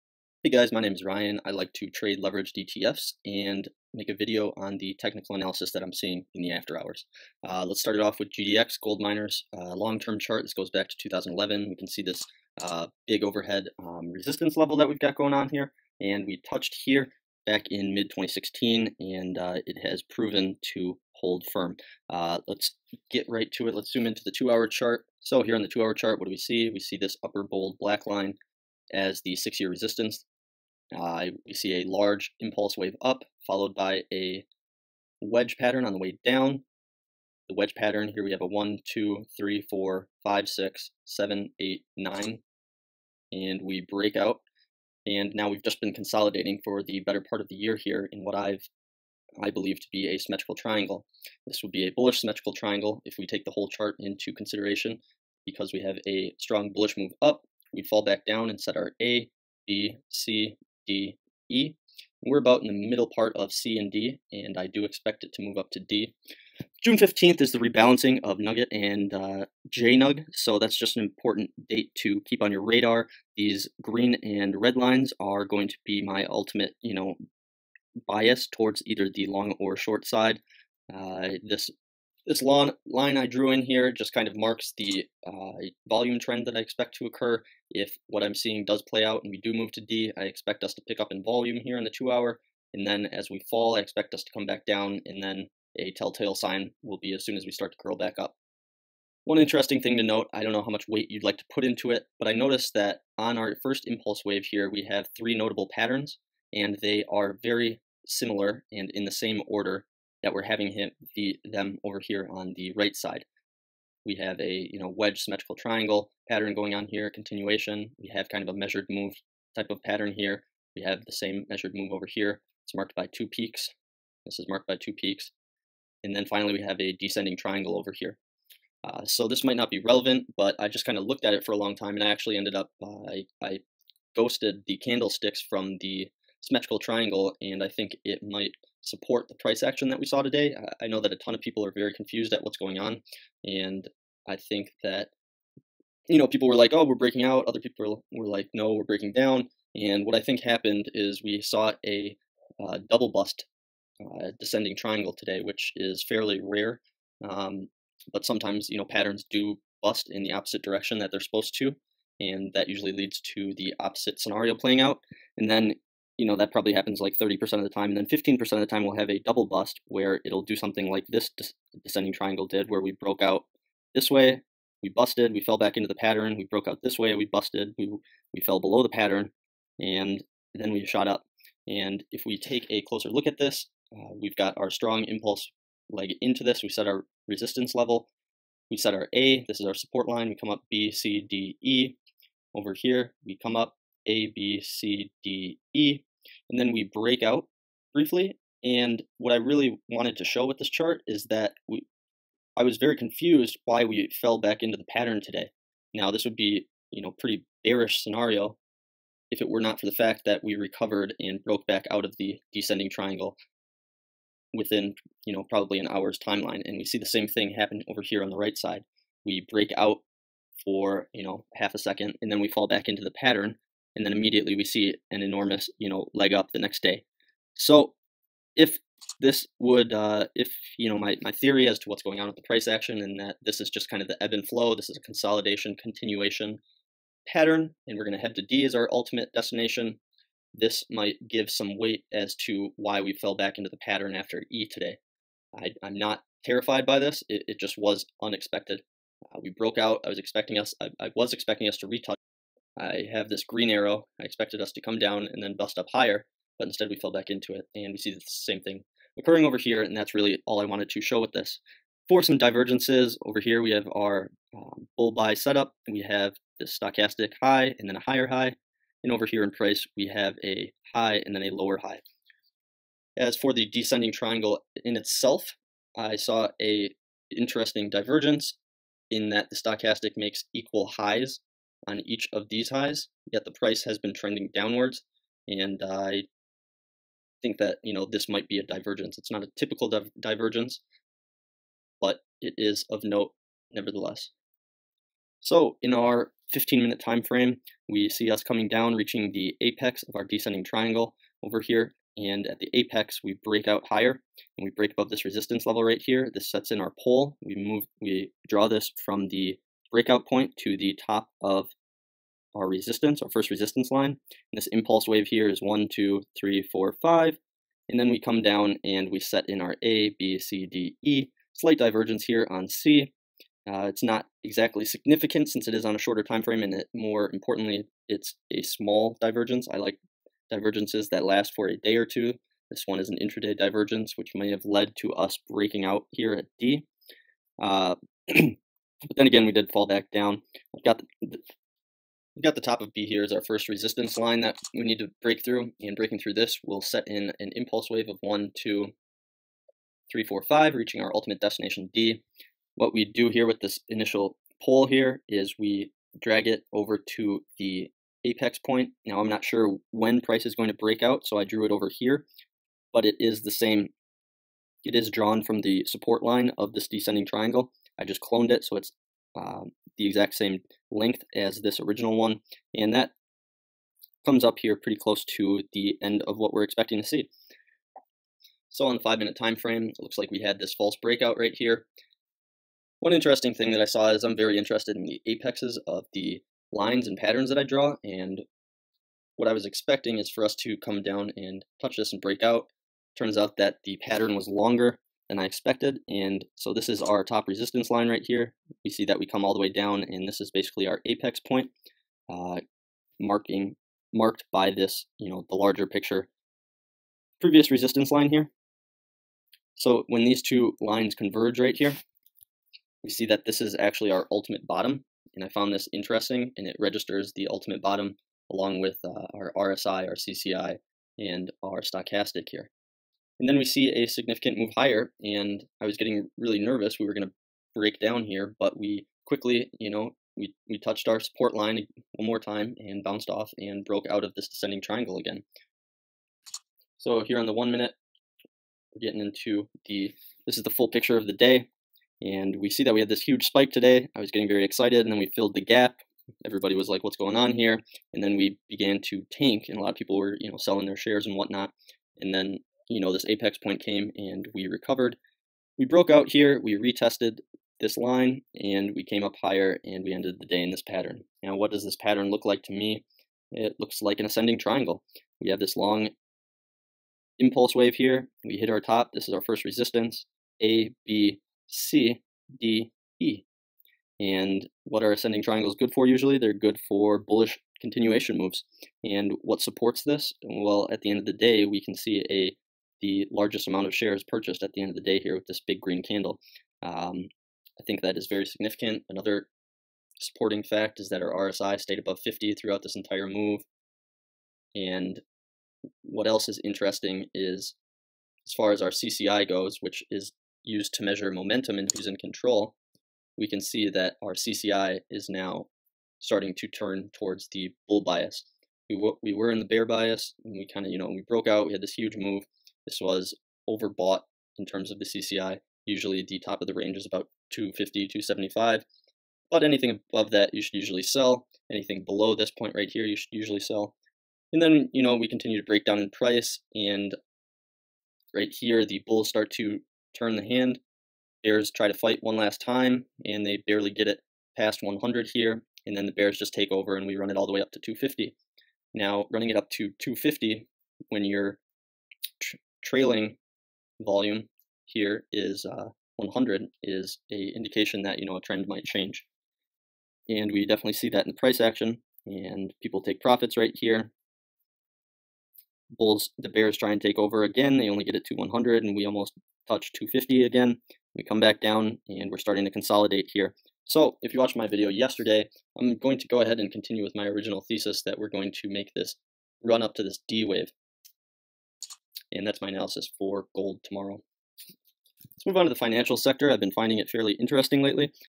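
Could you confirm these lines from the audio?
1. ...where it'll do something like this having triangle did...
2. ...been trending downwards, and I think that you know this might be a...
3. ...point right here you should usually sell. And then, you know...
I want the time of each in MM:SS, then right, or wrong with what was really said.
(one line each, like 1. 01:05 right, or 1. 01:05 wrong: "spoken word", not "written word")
1. 02:49 wrong: "descending", not "having"
2. 04:43 right
3. 08:42 right.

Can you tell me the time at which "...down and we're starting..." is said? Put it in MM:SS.
09:21.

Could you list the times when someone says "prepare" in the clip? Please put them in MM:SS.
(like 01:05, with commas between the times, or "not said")
not said.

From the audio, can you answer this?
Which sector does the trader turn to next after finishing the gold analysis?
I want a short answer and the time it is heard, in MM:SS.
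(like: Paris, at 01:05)
financial sector, at 09:35.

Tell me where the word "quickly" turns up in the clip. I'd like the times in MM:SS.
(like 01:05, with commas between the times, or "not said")
07:09.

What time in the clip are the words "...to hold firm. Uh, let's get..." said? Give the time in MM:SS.
00:20.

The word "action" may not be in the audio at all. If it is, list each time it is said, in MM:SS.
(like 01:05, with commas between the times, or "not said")
02:19, 03:52, 09:11.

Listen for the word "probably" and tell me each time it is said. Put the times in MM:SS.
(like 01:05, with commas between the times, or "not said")
02:46, 03:35.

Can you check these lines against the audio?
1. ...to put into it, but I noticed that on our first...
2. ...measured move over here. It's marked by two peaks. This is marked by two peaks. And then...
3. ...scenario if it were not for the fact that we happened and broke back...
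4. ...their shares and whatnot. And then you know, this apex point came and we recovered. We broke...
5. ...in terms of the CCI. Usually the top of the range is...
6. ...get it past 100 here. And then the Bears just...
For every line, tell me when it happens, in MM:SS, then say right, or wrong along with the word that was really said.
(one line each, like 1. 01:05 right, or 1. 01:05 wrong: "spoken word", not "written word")
1. 01:41 right
2. 02:01 right
3. 03:28 wrong: "recovered", not "happened"
4. 07:30 right
5. 08:34 right
6. 08:53 right.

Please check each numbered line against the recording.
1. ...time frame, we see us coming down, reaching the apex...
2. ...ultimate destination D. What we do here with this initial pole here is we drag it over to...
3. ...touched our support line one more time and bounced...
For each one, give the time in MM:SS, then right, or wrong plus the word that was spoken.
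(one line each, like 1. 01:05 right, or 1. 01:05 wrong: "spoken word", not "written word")
1. 04:56 right
2. 05:51 right
3. 07:10 right.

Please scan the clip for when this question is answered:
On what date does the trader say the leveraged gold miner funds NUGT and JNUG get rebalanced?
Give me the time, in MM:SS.
01:06.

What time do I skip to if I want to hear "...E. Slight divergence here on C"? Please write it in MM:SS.
05:21.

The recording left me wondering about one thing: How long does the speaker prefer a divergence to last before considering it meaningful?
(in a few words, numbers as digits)
a day or two.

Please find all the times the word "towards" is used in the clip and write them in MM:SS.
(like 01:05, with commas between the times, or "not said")
01:18, 08:27.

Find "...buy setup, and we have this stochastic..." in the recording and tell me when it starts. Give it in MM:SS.
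04:25.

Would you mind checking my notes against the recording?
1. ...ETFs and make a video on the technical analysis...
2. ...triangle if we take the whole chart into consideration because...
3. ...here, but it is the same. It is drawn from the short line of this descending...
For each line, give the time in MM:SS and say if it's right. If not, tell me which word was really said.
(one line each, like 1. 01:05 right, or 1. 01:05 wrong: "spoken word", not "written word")
1. 00:02 right
2. 00:52 right
3. 06:01 wrong: "support", not "short".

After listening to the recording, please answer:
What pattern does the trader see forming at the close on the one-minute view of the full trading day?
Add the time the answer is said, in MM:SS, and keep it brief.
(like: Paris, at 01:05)
ascending triangle, at 07:44.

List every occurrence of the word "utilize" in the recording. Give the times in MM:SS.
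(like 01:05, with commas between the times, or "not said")
not said.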